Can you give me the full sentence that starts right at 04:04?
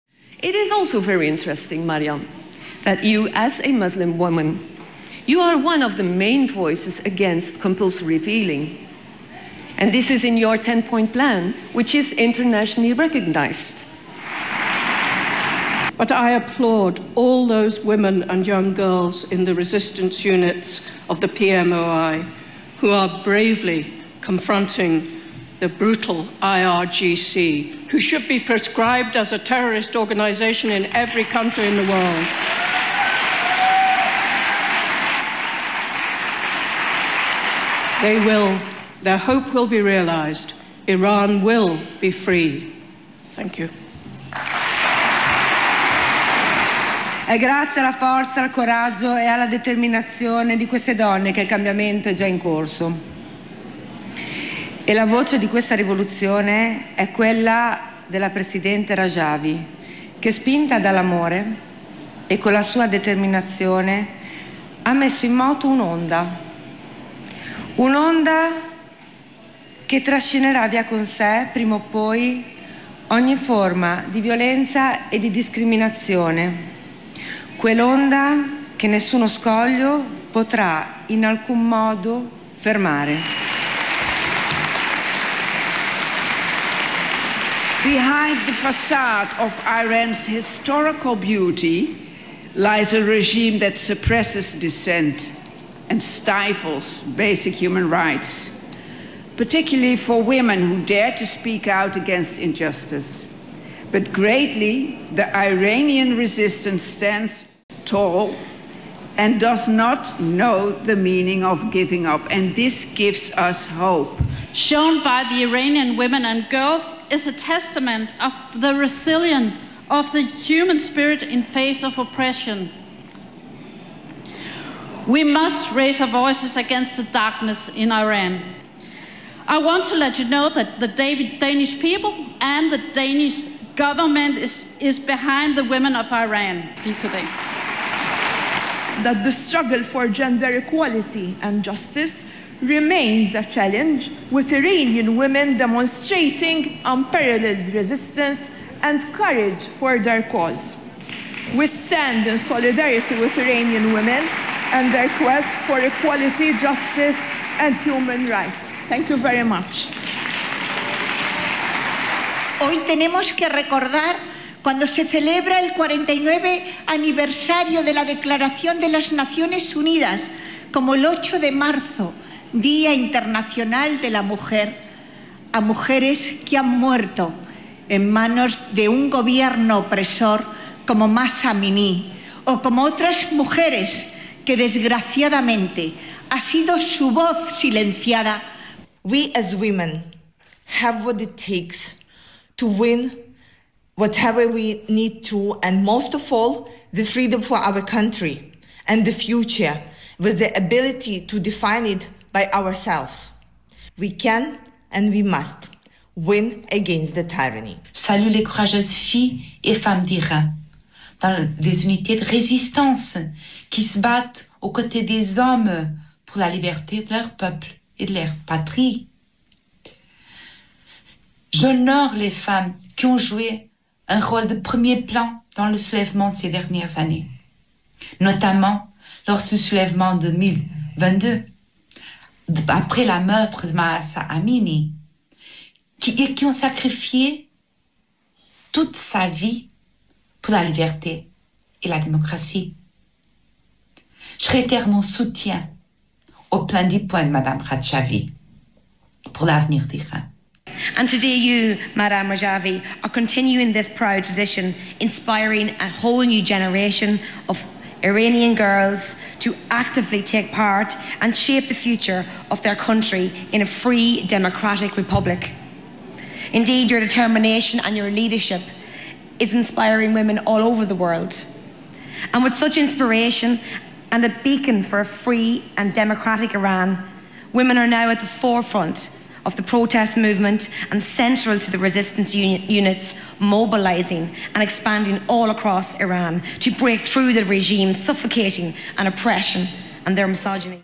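Je réitère mon soutien au plein des points de Mme Ratchavi pour l'avenir d'Iran.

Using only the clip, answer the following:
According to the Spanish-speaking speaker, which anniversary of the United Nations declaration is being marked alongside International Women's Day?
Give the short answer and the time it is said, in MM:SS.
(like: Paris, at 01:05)
49th, at 02:45.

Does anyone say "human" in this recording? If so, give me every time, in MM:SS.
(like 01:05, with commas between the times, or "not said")
01:37, 02:00, 02:37.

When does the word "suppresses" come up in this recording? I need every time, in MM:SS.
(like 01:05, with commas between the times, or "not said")
01:33.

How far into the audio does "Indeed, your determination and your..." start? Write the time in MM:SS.
04:26.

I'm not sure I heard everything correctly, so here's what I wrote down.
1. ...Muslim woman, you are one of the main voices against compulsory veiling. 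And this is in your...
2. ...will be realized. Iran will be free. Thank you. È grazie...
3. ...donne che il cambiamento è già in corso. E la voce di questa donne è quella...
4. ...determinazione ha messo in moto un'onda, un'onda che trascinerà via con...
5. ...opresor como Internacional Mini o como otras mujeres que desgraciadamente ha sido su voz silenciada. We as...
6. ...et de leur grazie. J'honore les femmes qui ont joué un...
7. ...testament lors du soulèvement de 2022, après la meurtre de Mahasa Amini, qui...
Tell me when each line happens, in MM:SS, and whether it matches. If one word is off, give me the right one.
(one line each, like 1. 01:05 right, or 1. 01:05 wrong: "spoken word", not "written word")
1. 00:03 right
2. 00:39 right
3. 00:50 wrong: "rivoluzione", not "donne"
4. 01:02 right
5. 02:59 wrong: "Massa", not "Internacional"
6. 03:37 wrong: "patrie", not "grazie"
7. 03:48 wrong: "notamment", not "testament".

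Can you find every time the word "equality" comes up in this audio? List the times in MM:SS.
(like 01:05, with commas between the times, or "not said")
02:20, 02:35.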